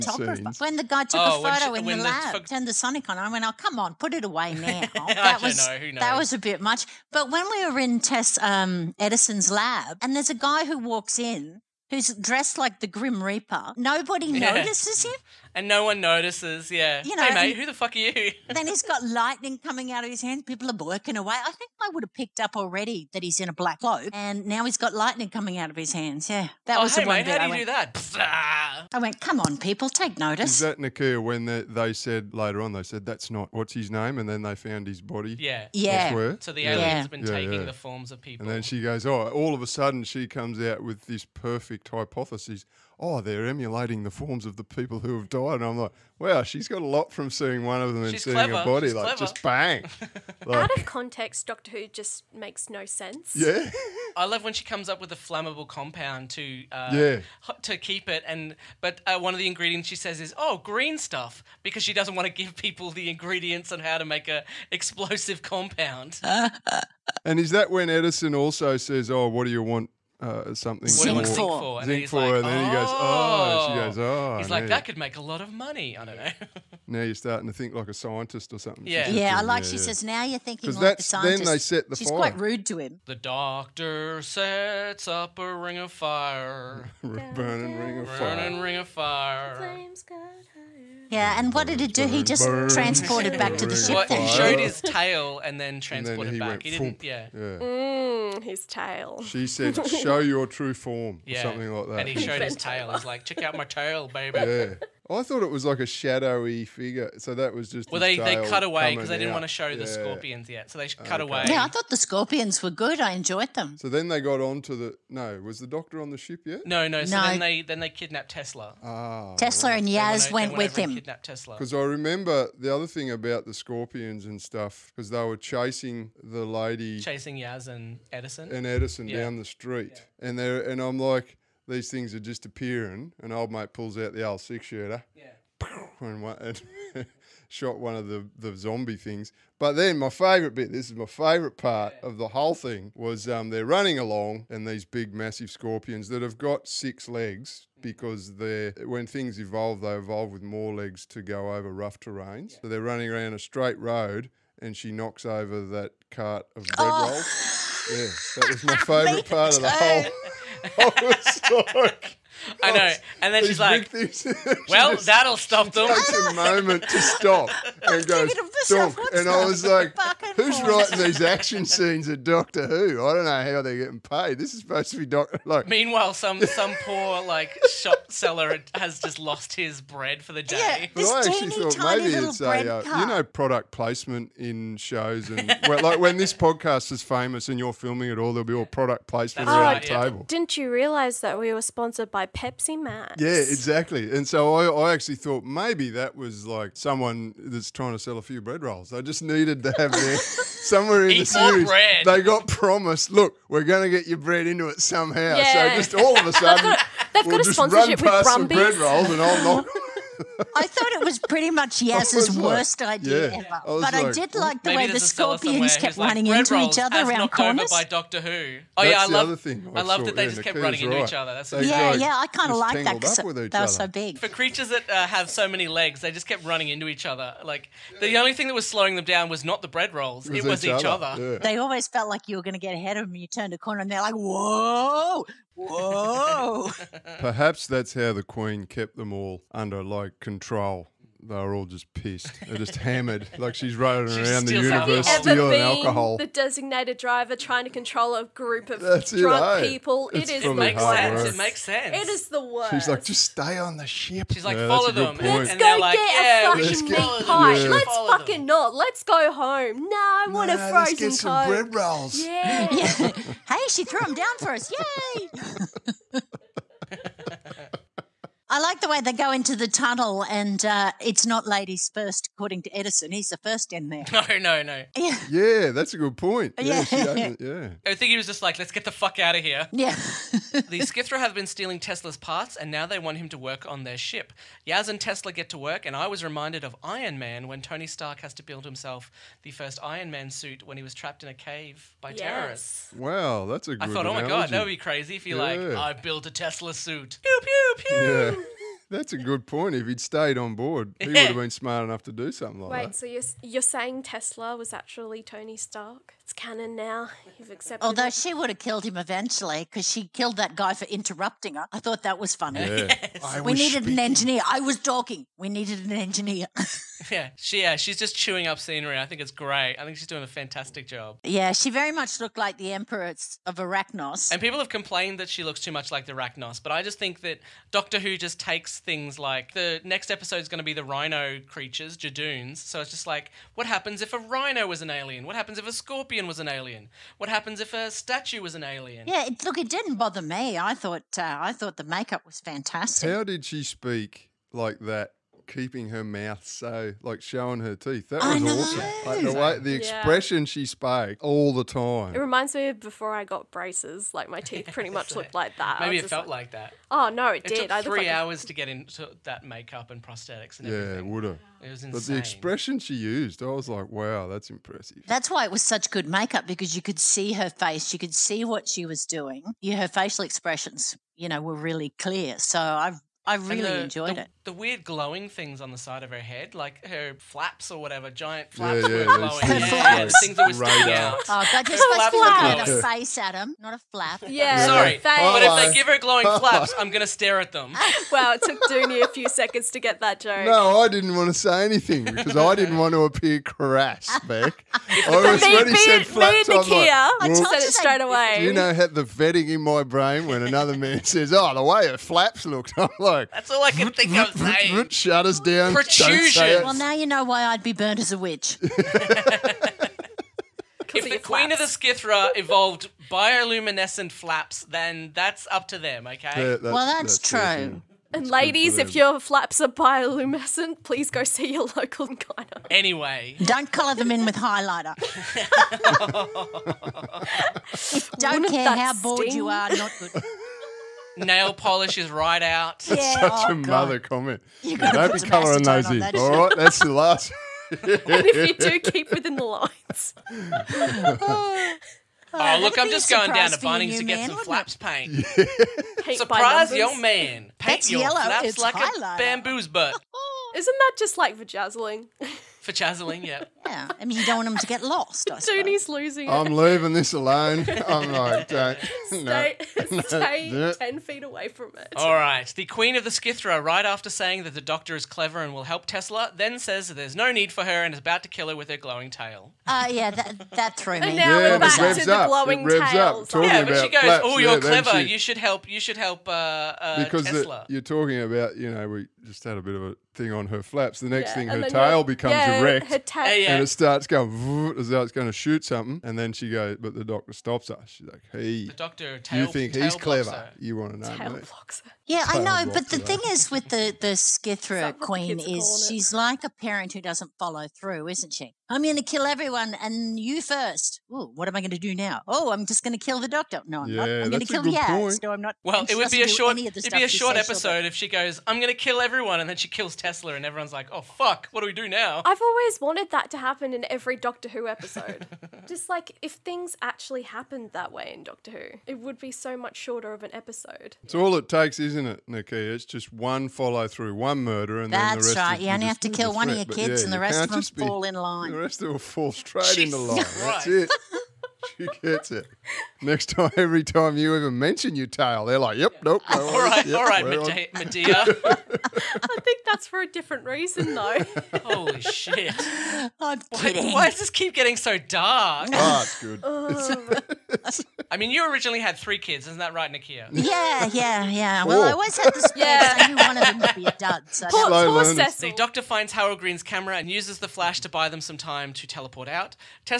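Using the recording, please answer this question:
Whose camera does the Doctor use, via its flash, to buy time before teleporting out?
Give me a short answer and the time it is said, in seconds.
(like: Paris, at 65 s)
Harold Green, at 556 s.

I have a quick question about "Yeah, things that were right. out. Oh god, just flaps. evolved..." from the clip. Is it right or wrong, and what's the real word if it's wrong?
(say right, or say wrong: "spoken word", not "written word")
wrong: "supposed", not "evolved".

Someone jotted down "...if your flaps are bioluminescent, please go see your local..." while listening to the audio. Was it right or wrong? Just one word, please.
right.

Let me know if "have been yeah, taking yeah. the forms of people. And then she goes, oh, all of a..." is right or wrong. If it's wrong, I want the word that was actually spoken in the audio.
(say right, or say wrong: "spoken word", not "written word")
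right.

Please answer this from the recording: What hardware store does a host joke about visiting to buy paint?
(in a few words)
Bunnings.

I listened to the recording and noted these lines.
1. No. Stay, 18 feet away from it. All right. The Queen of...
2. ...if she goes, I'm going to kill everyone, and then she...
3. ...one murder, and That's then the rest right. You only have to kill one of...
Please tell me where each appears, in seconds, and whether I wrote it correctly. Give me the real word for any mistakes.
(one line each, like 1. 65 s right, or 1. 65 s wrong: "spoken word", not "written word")
1. 459 s wrong: "10", not "18"
2. 507 s right
3. 524 s right.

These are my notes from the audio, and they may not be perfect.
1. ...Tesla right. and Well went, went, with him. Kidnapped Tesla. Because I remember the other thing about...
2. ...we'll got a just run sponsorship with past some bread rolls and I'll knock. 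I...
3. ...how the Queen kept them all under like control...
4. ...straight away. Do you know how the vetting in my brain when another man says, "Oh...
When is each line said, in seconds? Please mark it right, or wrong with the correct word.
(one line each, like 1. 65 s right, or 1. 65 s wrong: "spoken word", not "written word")
1. 119 s wrong: "Yaz", not "Well"
2. 207 s right
3. 237 s right
4. 397 s right.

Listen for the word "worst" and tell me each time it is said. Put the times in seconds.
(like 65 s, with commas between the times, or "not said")
212 s, 252 s.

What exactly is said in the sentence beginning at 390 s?
No, I didn't want to say anything because I didn't want to appear crass, Beck.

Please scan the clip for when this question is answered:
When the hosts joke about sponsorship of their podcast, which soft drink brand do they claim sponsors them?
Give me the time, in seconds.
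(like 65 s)
192 s.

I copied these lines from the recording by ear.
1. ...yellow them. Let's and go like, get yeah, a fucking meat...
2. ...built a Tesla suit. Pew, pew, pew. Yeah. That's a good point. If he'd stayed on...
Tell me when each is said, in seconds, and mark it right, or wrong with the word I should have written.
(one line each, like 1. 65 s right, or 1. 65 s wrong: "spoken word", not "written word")
1. 254 s wrong: "follow", not "yellow"
2. 295 s right.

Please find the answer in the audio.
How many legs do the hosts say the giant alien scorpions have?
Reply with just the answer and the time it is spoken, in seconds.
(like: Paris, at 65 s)
6, at 146 s.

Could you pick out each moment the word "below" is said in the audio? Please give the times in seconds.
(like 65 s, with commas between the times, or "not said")
not said.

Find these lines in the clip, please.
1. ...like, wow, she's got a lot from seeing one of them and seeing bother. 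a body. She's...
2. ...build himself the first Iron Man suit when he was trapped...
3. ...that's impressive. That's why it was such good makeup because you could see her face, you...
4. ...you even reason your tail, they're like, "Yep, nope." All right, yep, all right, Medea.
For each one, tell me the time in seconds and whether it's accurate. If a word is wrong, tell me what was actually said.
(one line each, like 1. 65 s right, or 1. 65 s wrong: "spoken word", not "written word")
1. 45 s wrong: "clever", not "bother"
2. 288 s right
3. 364 s right
4. 534 s wrong: "mention", not "reason".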